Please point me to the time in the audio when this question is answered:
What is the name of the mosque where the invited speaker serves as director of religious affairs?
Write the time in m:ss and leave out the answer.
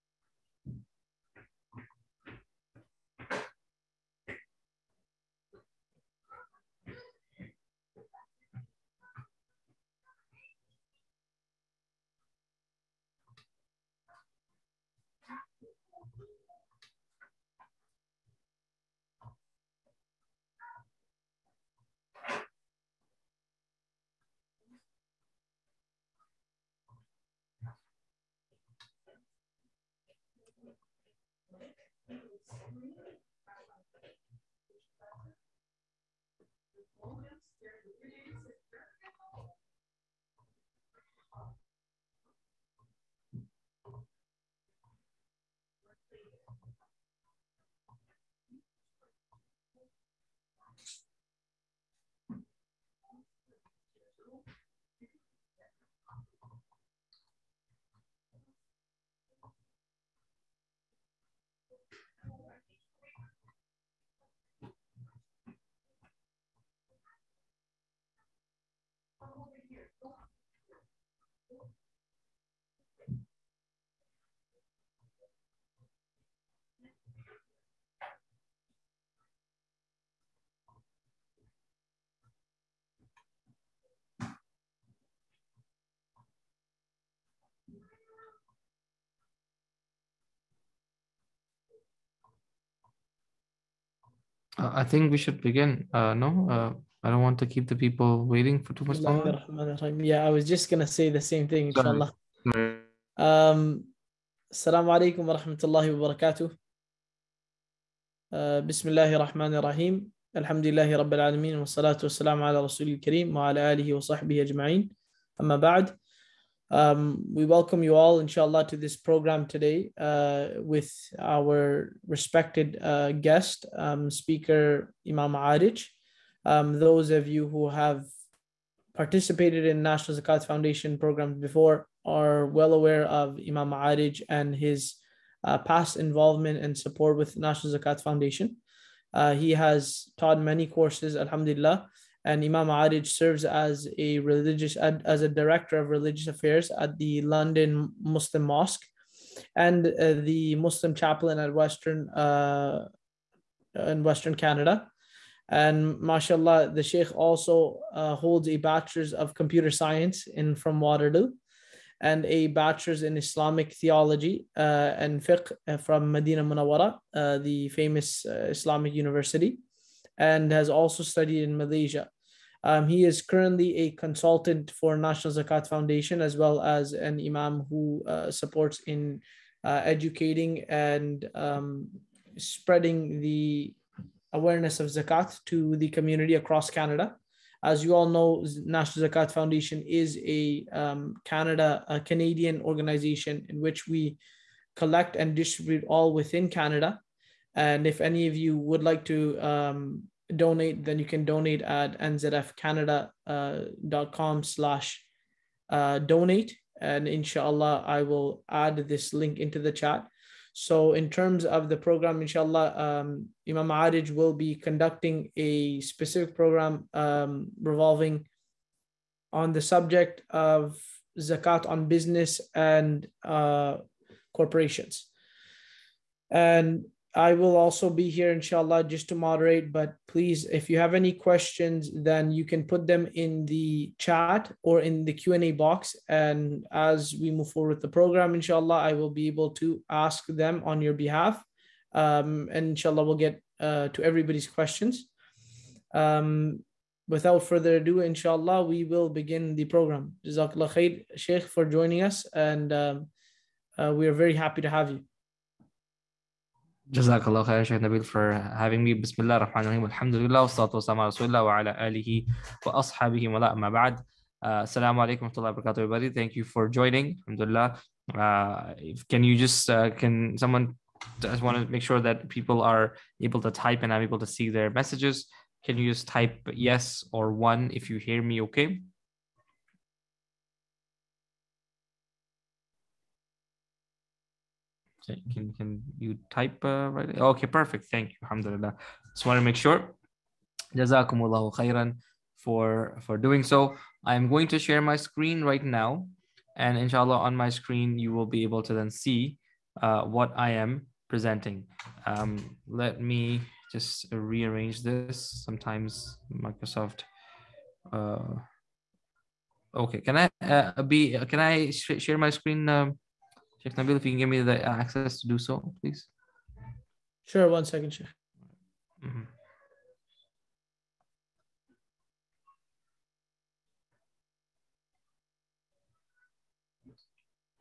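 2:27.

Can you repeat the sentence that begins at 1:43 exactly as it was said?
Um, assalamu alaikum wa rahmatullahi wa barakatuh.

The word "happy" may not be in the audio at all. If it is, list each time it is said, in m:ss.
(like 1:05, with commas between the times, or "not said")
4:14.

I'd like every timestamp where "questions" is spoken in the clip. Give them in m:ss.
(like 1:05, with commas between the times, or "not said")
3:51, 4:04.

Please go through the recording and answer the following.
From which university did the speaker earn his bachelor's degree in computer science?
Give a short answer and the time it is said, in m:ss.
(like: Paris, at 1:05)
Waterloo, at 2:40.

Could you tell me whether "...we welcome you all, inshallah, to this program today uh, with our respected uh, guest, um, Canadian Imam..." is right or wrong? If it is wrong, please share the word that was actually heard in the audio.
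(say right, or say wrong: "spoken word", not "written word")
wrong: "Speaker", not "Canadian".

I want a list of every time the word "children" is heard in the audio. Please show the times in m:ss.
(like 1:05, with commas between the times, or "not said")
not said.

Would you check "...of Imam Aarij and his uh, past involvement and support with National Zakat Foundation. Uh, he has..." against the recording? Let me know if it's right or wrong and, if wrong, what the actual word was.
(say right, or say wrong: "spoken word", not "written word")
right.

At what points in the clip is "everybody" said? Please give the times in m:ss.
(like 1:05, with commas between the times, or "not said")
4:04, 4:25.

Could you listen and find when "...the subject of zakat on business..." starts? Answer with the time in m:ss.
3:39.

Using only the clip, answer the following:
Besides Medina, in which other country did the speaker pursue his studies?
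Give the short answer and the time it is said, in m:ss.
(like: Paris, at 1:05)
Malaysia, at 2:51.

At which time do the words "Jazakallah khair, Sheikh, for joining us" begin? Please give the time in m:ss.
4:10.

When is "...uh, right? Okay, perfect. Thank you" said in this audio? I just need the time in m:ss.
4:46.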